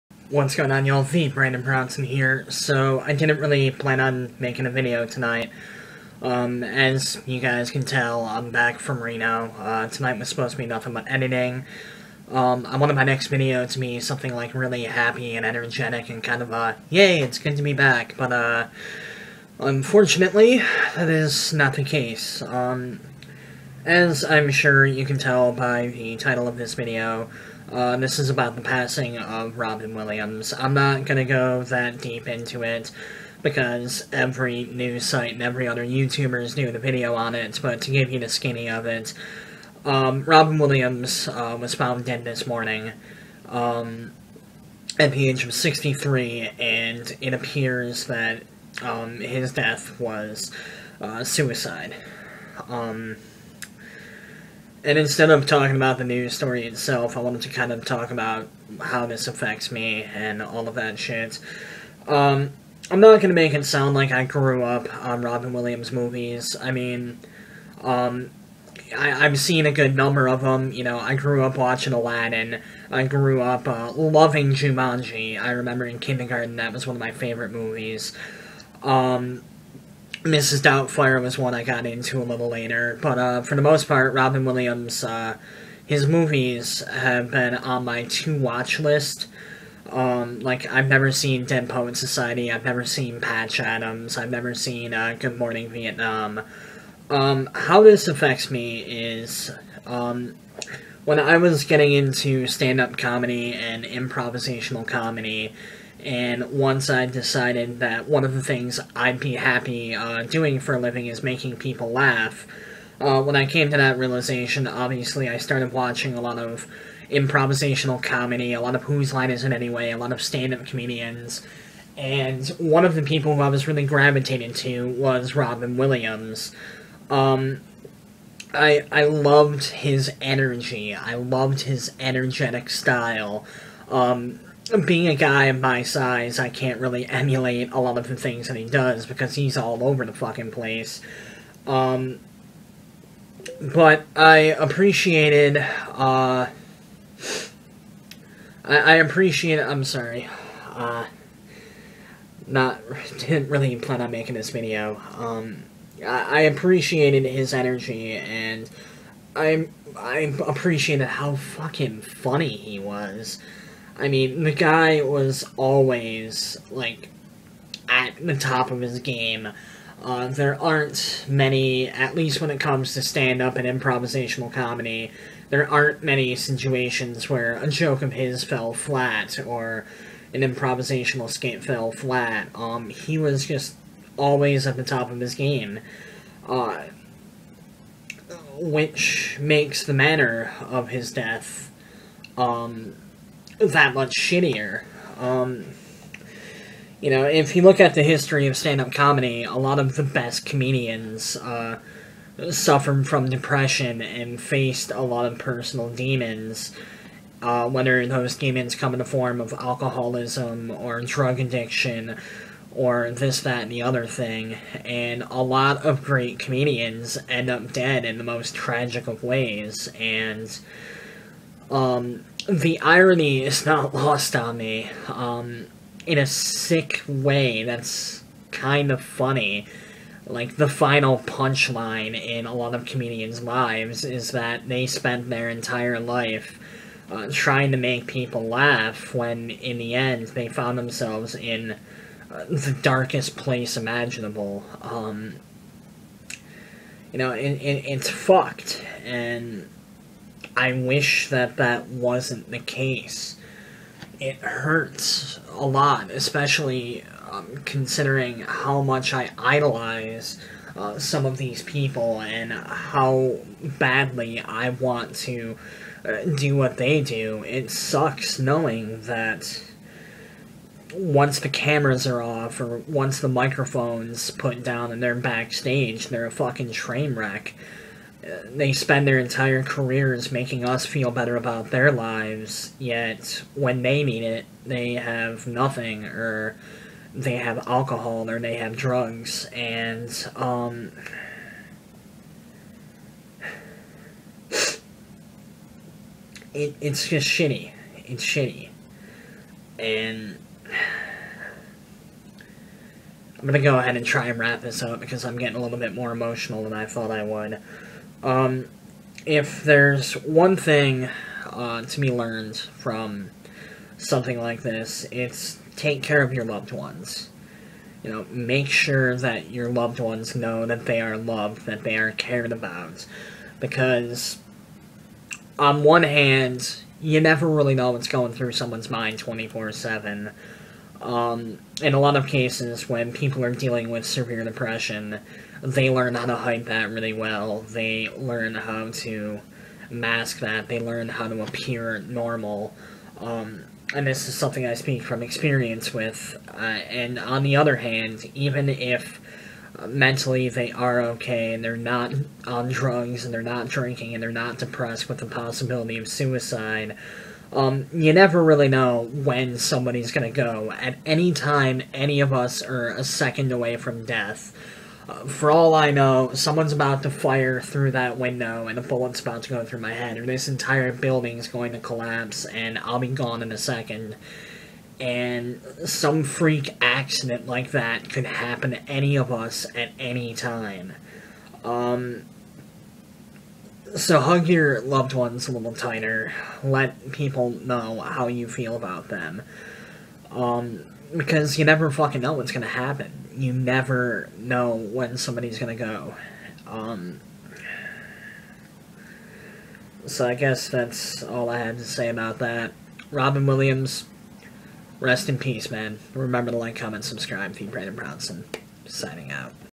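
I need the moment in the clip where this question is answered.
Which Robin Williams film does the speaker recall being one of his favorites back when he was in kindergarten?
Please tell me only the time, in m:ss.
1:14.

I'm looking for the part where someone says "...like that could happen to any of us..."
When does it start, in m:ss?
6:17.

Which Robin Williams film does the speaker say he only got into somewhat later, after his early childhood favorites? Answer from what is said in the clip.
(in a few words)
Mrs. Doubtfire.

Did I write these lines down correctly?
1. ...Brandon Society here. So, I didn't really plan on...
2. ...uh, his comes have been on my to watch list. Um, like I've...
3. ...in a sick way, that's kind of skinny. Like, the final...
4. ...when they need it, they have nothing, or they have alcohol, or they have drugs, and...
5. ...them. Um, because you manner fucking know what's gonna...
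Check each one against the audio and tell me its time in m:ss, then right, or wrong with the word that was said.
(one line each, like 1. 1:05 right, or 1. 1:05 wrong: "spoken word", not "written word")
1. 0:01 wrong: "Brownson", not "Society"
2. 1:25 wrong: "movies", not "comes"
3. 3:46 wrong: "funny", not "skinny"
4. 4:43 right
5. 6:29 wrong: "never", not "manner".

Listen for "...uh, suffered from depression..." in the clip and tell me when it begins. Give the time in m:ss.
3:21.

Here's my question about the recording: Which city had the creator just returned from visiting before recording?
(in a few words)
Reno.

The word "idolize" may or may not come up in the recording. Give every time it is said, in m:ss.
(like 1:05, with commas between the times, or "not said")
4:19.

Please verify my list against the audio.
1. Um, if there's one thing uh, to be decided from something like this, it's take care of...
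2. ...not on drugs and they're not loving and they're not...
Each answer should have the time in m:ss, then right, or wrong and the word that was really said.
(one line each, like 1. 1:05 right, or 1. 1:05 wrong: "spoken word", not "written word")
1. 5:08 wrong: "learned", not "decided"
2. 5:51 wrong: "drinking", not "loving".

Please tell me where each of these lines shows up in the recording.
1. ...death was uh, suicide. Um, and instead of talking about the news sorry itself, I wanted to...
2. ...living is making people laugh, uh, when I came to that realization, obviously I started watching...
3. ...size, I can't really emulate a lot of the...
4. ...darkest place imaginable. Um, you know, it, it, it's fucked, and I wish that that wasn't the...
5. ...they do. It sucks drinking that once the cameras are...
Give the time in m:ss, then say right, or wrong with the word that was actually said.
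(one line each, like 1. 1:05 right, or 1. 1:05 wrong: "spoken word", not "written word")
1. 0:49 wrong: "story", not "sorry"
2. 1:50 right
3. 2:15 right
4. 4:02 right
5. 4:26 wrong: "knowing", not "drinking".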